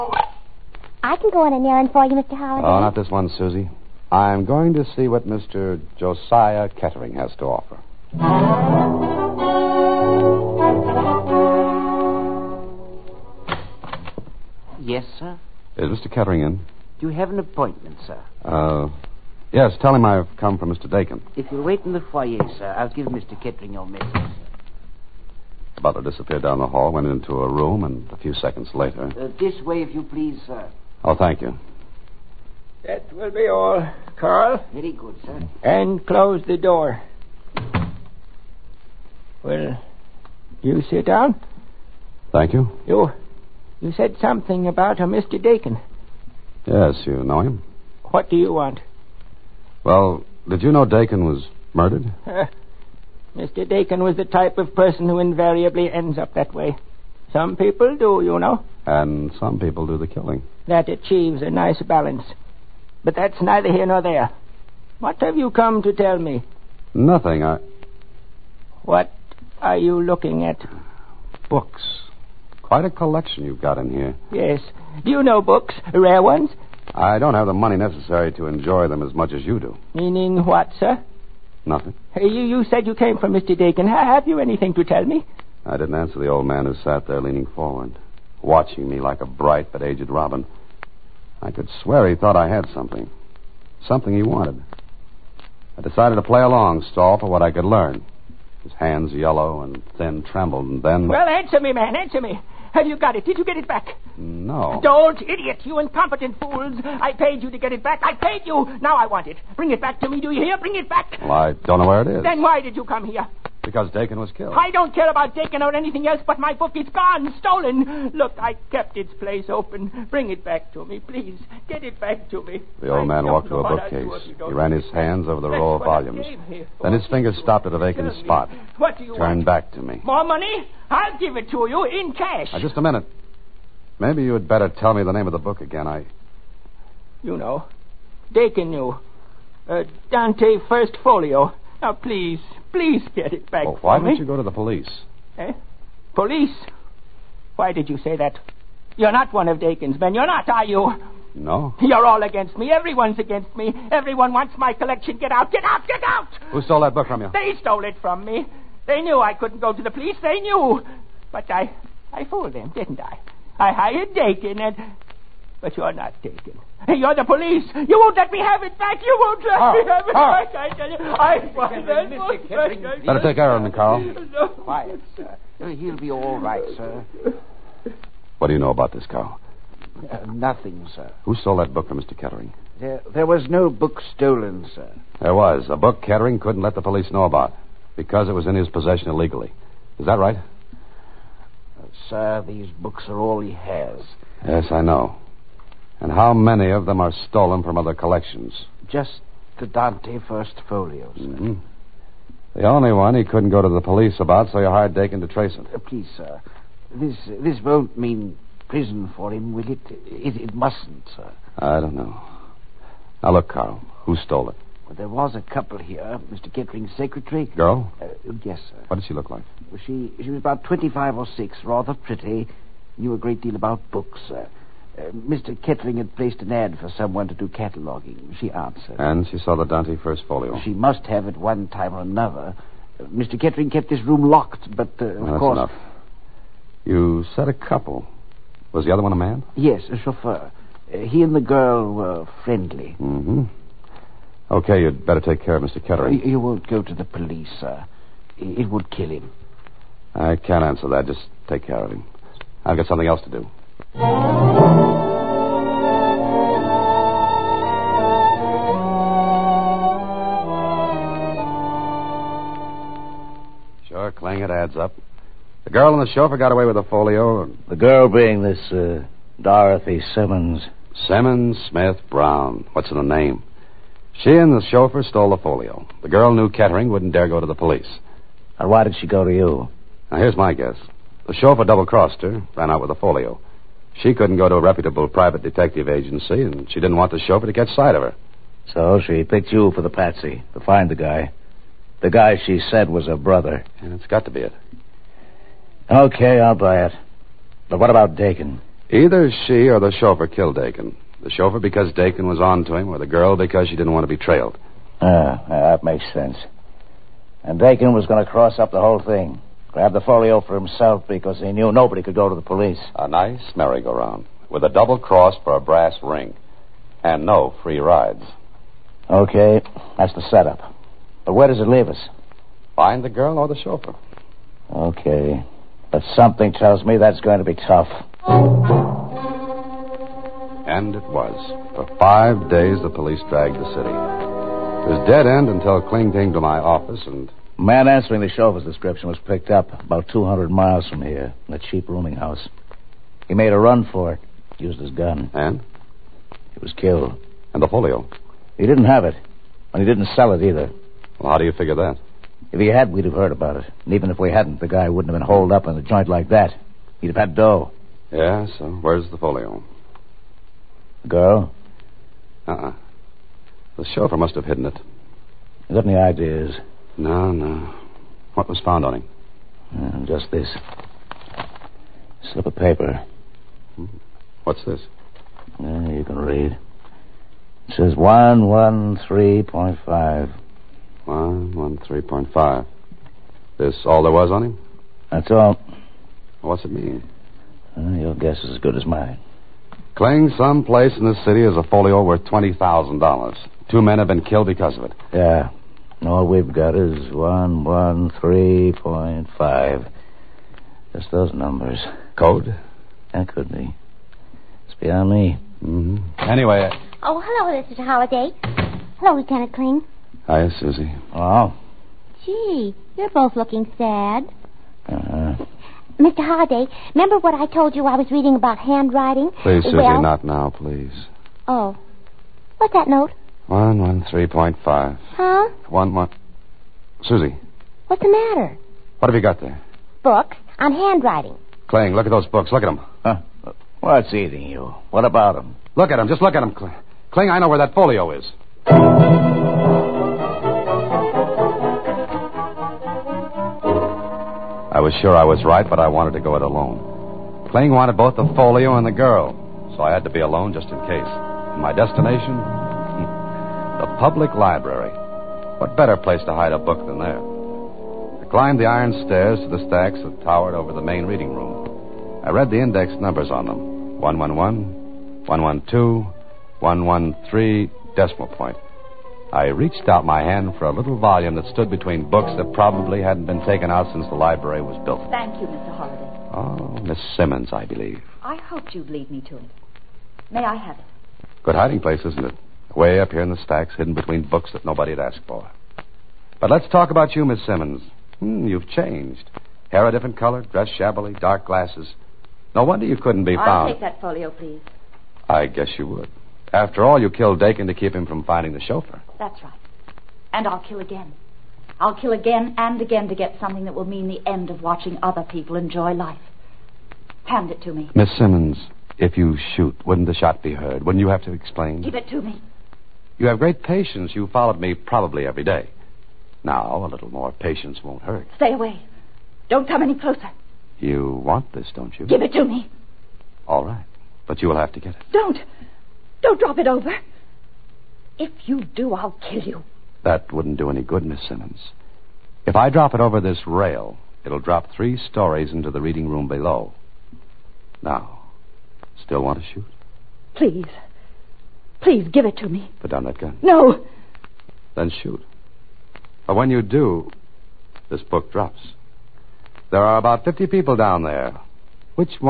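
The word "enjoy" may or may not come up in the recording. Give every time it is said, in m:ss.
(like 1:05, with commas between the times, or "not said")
1:18, 8:25.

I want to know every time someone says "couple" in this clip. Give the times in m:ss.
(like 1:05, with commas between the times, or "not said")
3:35, 3:57.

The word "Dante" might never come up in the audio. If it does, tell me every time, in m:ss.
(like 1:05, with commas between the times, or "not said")
2:20, 3:19, 3:49.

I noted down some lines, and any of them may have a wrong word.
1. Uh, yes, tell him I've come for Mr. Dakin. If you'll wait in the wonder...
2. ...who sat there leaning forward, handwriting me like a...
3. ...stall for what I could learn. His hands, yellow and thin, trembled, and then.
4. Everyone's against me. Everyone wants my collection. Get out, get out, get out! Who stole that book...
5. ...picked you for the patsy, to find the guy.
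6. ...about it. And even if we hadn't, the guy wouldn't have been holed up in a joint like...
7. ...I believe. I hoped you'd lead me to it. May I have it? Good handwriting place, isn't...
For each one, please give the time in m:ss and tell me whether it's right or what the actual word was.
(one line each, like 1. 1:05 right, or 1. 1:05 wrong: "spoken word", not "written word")
1. 0:18 wrong: "foyer", not "wonder"
2. 1:26 wrong: "watching", not "handwriting"
3. 1:36 right
4. 2:32 right
5. 4:49 right
6. 5:53 right
7. 7:57 wrong: "hiding", not "handwriting".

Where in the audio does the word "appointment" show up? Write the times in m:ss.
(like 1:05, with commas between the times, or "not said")
0:17.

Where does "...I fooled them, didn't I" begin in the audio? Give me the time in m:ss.
2:42.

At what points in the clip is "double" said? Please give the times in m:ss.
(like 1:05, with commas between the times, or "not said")
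4:41, 5:14.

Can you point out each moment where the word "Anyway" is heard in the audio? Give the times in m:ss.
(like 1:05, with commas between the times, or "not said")
6:46.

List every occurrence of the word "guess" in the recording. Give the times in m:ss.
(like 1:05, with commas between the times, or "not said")
4:40, 6:28, 8:15.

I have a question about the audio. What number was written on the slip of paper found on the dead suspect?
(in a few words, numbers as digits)
113.5.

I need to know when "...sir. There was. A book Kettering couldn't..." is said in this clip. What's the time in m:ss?
3:04.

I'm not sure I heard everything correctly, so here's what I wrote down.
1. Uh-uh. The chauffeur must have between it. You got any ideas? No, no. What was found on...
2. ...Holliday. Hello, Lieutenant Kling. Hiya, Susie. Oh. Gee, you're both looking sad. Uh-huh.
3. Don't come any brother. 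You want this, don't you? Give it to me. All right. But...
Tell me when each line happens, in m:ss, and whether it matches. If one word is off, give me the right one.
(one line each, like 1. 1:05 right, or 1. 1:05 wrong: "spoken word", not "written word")
1. 6:02 wrong: "hidden", not "between"
2. 6:47 right
3. 8:39 wrong: "closer", not "brother".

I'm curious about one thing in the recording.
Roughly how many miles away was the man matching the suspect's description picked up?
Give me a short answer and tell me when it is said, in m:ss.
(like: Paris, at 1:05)
200, at 5:40.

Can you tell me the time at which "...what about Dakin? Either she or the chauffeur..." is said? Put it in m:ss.
4:57.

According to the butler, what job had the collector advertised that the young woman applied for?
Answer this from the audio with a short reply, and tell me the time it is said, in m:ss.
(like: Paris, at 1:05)
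Cataloging, at 3:47.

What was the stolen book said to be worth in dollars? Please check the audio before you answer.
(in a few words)
$20,000.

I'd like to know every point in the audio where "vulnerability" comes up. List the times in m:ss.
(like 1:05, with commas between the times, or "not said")
not said.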